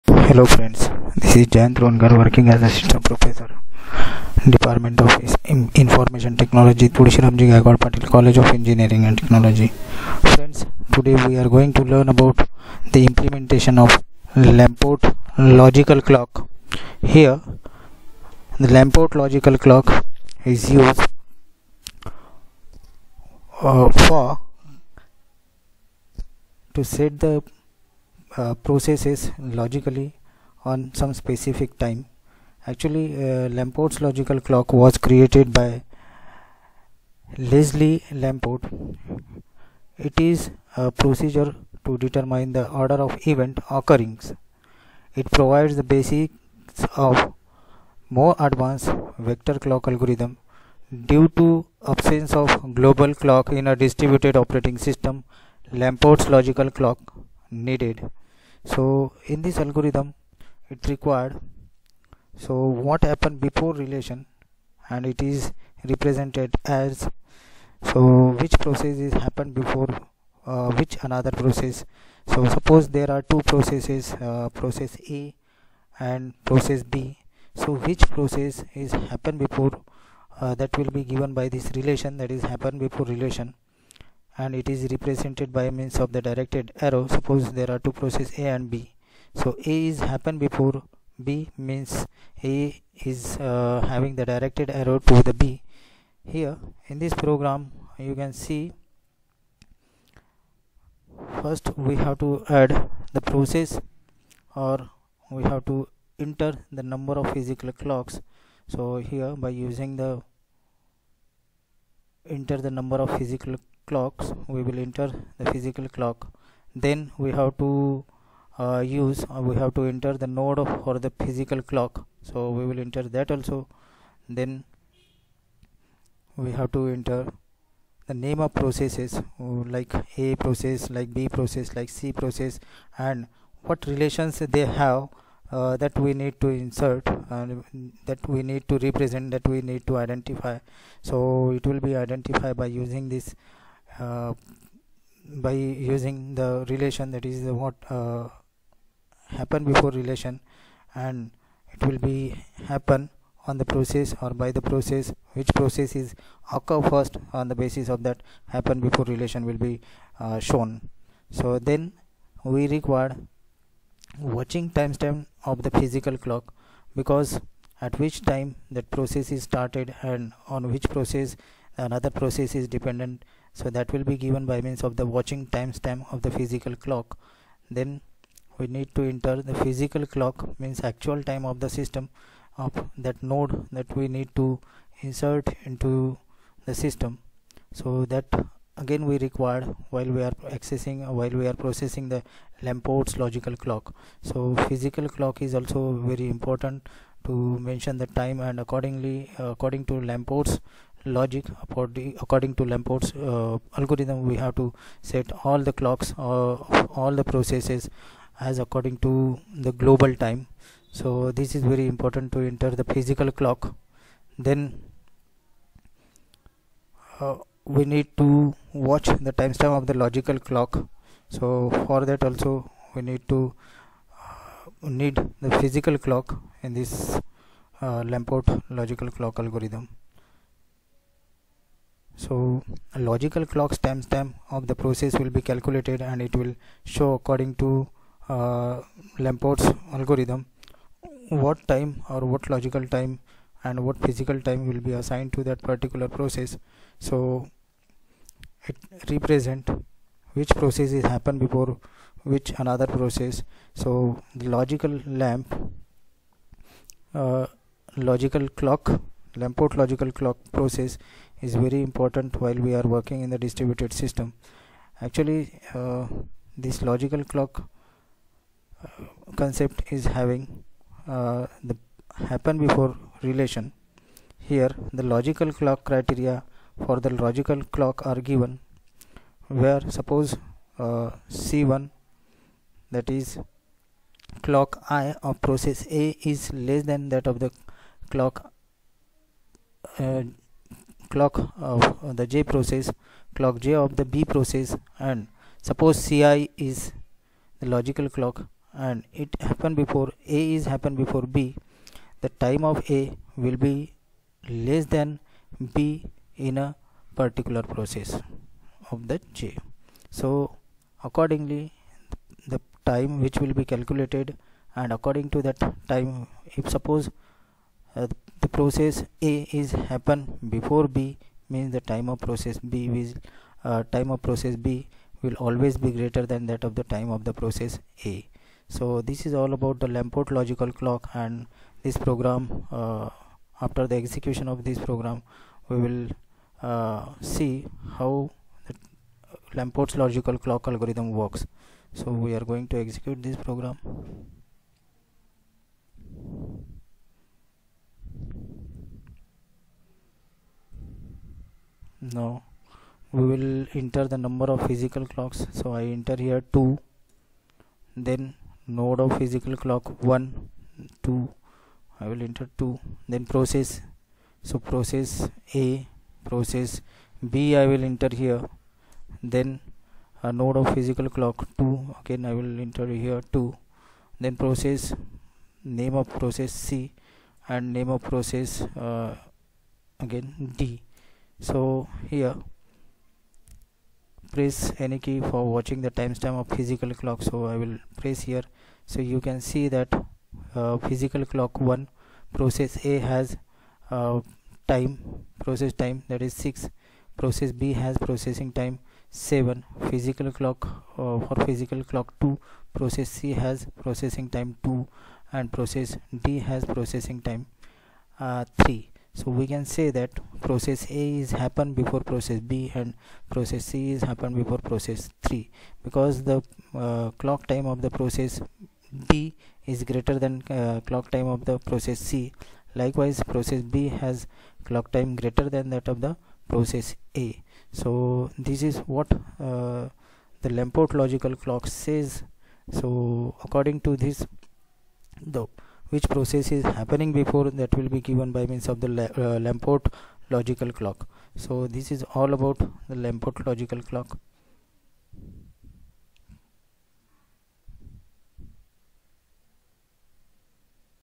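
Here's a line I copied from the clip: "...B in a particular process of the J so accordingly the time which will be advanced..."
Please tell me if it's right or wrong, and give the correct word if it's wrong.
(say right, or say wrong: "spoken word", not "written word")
wrong: "calculated", not "advanced".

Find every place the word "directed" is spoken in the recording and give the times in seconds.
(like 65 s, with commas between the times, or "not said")
86 s, 94 s.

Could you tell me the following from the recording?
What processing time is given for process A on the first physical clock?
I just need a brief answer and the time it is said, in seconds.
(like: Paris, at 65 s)
6, at 396 s.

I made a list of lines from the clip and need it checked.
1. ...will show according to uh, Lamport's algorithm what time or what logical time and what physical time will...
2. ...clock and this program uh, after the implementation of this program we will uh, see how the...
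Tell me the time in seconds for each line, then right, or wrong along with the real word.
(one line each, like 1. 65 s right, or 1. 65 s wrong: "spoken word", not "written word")
1. 236 s right
2. 330 s wrong: "execution", not "implementation".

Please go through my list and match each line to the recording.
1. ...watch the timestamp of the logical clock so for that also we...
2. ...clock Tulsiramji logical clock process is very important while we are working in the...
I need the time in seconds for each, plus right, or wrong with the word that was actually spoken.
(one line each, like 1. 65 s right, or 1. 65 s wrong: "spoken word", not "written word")
1. 218 s right
2. 258 s wrong: "Lamport", not "Tulsiramji".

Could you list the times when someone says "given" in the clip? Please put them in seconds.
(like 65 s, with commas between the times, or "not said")
81 s, 174 s, 278 s, 438 s.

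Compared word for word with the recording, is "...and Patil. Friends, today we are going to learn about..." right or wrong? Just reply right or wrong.
wrong.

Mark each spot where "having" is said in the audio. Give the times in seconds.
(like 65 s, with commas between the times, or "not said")
93 s, 270 s.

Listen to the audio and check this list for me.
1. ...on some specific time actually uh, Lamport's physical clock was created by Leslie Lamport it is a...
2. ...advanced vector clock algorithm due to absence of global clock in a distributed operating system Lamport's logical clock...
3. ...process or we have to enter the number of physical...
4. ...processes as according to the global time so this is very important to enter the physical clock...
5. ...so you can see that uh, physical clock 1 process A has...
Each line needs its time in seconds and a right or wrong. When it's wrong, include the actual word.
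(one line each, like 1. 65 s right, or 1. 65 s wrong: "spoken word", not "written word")
1. 30 s wrong: "logical", not "physical"
2. 48 s right
3. 103 s right
4. 207 s right
5. 388 s right.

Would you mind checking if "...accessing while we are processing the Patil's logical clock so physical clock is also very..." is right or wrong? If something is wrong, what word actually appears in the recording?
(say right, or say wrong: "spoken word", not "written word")
wrong: "Lamport", not "Patil".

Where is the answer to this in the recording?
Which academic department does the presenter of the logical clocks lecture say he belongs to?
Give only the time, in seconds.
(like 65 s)
4 s.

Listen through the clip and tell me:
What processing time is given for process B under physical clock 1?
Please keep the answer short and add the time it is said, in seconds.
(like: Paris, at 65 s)
7, at 397 s.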